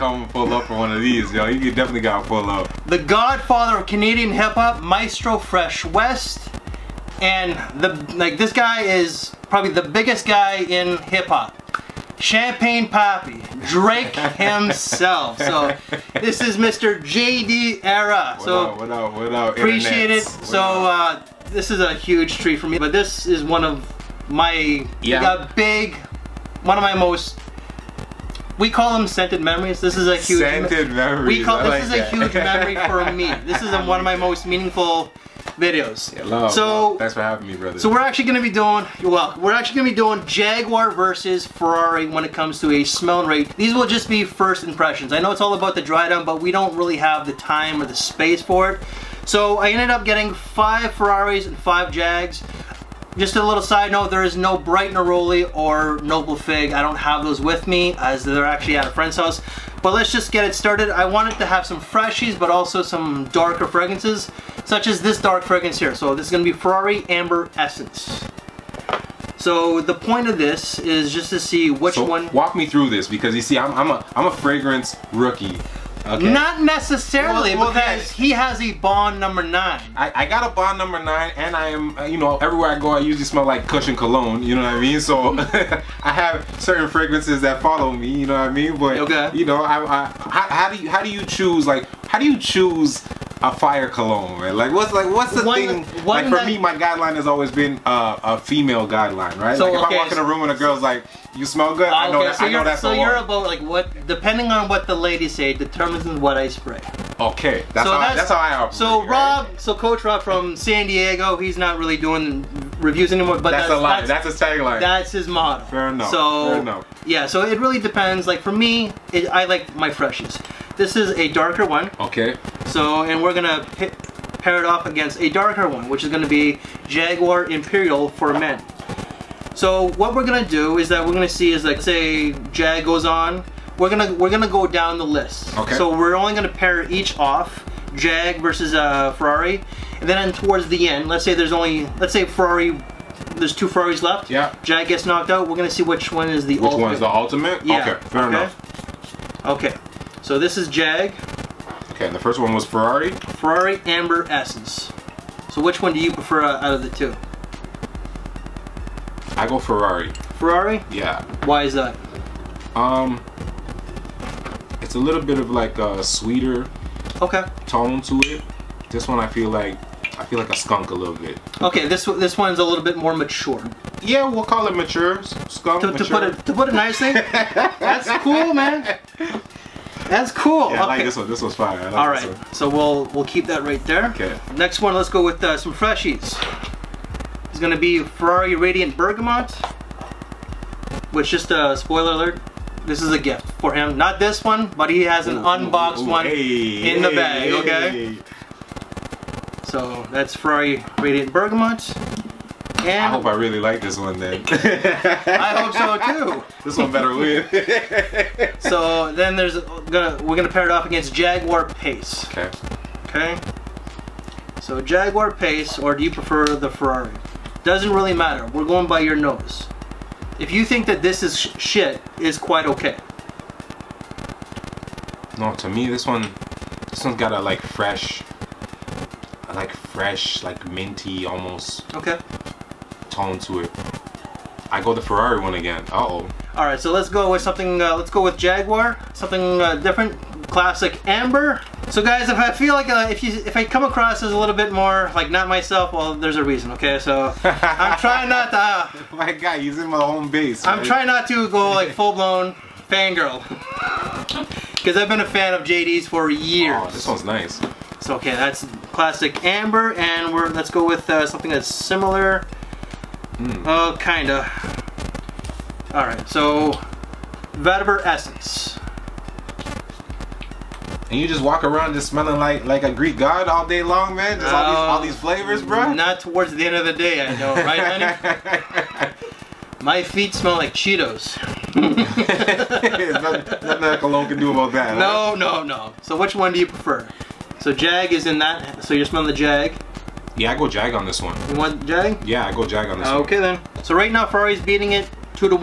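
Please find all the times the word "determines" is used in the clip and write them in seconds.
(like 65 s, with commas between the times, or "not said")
105 s.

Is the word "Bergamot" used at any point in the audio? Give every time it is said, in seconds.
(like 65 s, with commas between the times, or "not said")
188 s, 201 s.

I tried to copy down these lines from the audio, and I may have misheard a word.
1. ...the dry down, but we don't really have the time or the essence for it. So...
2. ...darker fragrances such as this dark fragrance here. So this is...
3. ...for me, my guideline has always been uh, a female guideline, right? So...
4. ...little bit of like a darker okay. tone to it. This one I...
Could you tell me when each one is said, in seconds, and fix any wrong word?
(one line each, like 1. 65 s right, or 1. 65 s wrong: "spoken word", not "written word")
1. 45 s wrong: "space", not "essence"
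2. 63 s right
3. 96 s right
4. 164 s wrong: "sweeter", not "darker".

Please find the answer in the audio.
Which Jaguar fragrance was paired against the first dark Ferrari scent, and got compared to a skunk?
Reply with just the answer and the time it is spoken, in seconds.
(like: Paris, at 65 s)
Jaguar Imperial, at 126 s.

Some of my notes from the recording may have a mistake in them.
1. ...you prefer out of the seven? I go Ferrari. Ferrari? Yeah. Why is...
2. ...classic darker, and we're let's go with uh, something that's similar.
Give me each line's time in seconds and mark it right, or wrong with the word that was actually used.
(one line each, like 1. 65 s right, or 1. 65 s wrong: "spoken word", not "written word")
1. 155 s wrong: "two", not "seven"
2. 258 s wrong: "amber", not "darker".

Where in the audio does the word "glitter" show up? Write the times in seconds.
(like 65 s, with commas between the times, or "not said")
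not said.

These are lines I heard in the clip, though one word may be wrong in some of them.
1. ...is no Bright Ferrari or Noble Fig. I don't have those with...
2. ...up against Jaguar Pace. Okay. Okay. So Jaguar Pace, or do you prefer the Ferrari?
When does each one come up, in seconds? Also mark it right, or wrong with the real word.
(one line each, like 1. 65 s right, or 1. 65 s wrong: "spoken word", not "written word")
1. 54 s wrong: "Neroli", not "Ferrari"
2. 210 s right.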